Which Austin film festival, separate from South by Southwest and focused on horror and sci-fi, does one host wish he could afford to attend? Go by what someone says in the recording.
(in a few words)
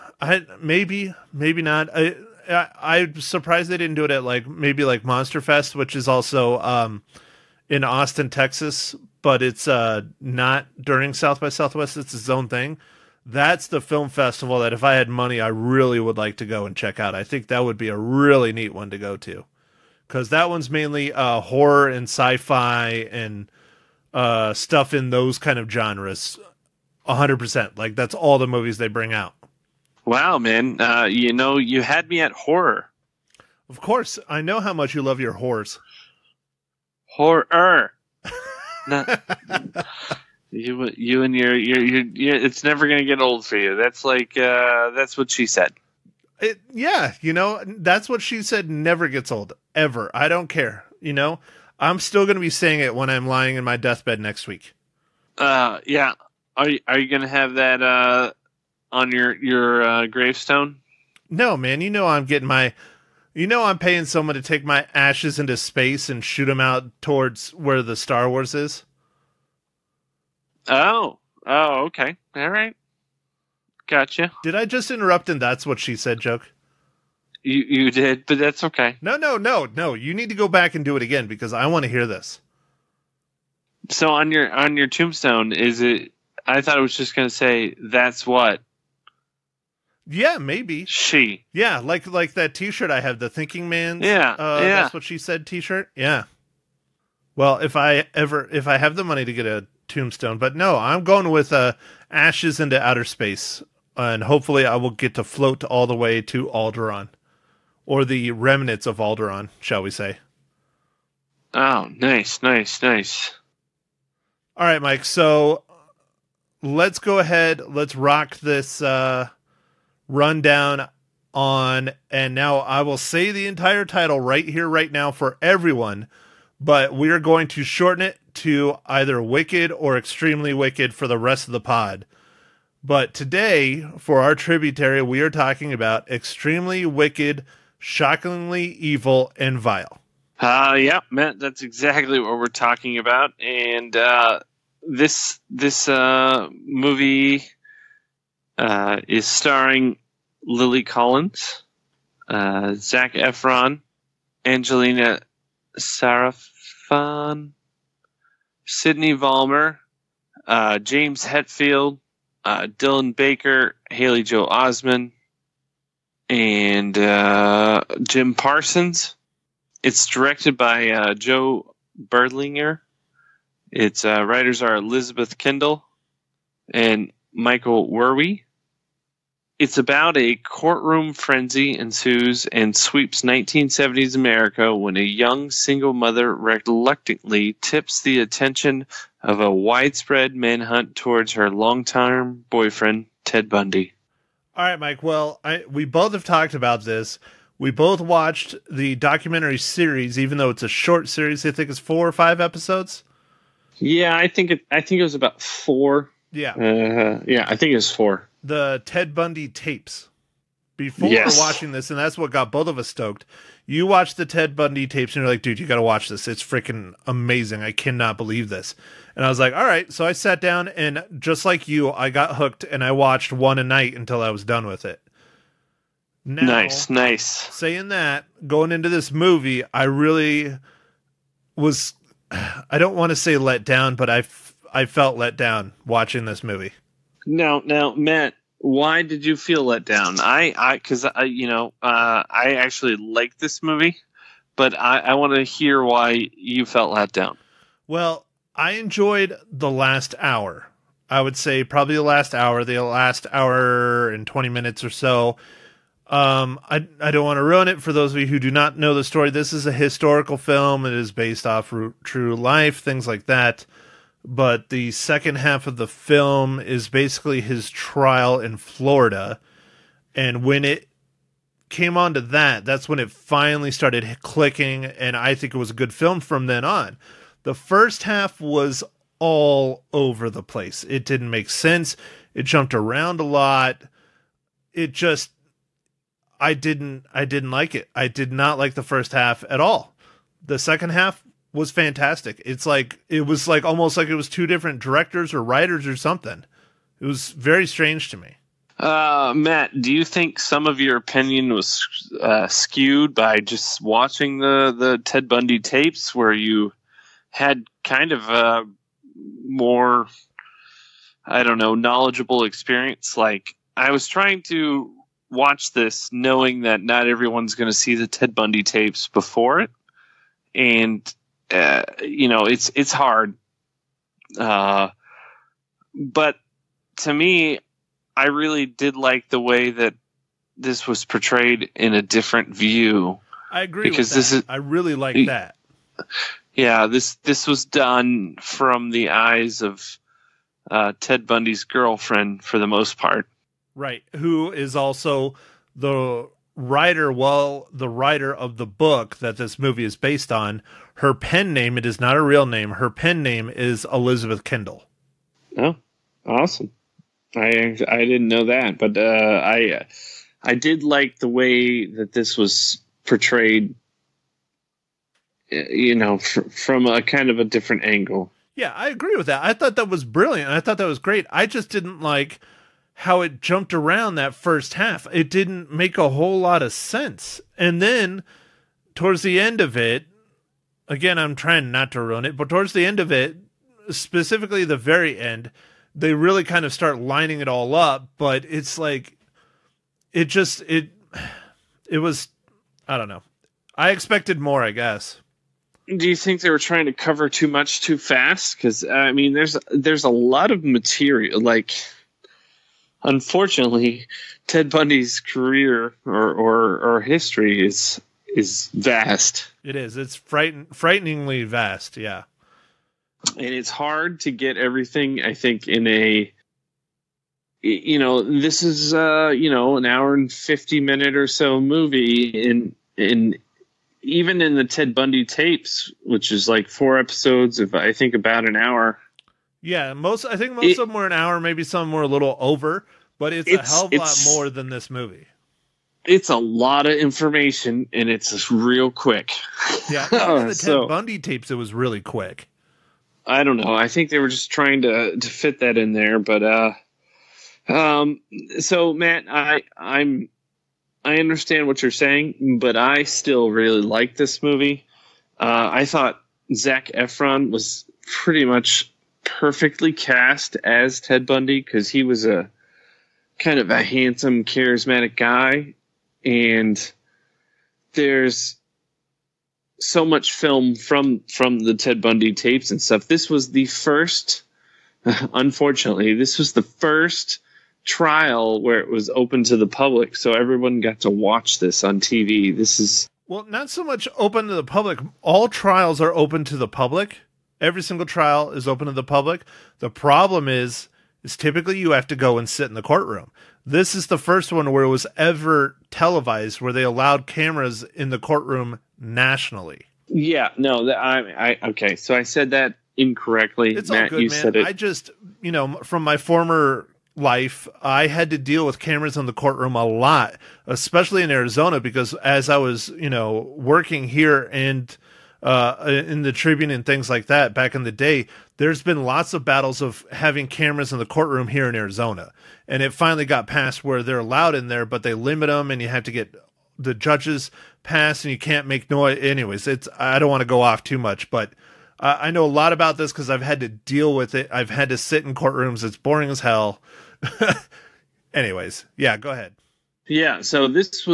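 Monster Fest.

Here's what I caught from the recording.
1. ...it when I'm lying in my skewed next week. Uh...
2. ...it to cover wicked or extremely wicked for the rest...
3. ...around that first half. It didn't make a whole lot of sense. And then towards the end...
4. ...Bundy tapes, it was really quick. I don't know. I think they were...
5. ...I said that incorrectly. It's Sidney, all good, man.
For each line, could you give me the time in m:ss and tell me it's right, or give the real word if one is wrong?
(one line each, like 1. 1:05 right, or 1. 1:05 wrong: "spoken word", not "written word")
1. 0:52 wrong: "deathbed", not "skewed"
2. 2:08 wrong: "either", not "cover"
3. 6:13 right
4. 7:20 right
5. 8:22 wrong: "Matt", not "Sidney".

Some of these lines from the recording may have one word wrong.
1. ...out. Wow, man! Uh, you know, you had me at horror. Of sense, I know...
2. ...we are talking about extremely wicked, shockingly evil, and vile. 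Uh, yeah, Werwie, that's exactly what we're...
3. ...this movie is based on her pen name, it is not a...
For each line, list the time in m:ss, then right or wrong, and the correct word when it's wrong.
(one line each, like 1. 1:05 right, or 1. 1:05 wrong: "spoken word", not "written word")
1. 0:29 wrong: "course", not "sense"
2. 2:15 wrong: "Matt", not "Werwie"
3. 5:49 right.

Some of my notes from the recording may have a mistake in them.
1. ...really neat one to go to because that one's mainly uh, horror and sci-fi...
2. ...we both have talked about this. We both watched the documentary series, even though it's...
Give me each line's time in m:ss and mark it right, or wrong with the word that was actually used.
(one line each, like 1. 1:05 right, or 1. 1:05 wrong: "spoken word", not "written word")
1. 0:17 right
2. 3:15 right.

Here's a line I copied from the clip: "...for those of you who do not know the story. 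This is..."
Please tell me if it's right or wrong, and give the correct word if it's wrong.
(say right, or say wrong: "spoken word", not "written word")
right.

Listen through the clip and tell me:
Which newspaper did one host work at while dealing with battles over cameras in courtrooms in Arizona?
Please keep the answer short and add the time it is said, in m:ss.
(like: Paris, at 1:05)
the Tribune, at 8:36.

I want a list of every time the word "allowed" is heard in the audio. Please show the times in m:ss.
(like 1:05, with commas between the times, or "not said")
8:16, 8:44.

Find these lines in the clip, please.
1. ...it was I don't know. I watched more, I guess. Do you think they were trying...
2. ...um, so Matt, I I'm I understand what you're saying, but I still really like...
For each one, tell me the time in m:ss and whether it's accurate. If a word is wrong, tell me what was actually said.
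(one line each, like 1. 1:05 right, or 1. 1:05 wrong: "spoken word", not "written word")
1. 6:31 wrong: "expected", not "watched"
2. 7:27 right.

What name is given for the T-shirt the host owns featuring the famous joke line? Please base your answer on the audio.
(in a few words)
the Thinking Man.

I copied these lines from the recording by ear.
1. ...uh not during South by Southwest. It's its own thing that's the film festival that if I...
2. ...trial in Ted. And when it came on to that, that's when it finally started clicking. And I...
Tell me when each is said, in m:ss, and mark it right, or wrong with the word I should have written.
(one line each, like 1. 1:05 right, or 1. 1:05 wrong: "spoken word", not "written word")
1. 0:09 right
2. 4:27 wrong: "Florida", not "Ted".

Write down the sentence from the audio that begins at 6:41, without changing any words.
Like, unfortunately, Ted Bundy's career or or, or history is is vast.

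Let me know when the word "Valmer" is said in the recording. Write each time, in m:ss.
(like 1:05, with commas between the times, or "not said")
2:39.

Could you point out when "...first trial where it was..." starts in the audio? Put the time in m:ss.
7:56.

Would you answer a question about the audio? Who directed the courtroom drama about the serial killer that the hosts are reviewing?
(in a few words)
Joe Berlinger.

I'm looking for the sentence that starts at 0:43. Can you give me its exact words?
That's like, uh, that's what she said.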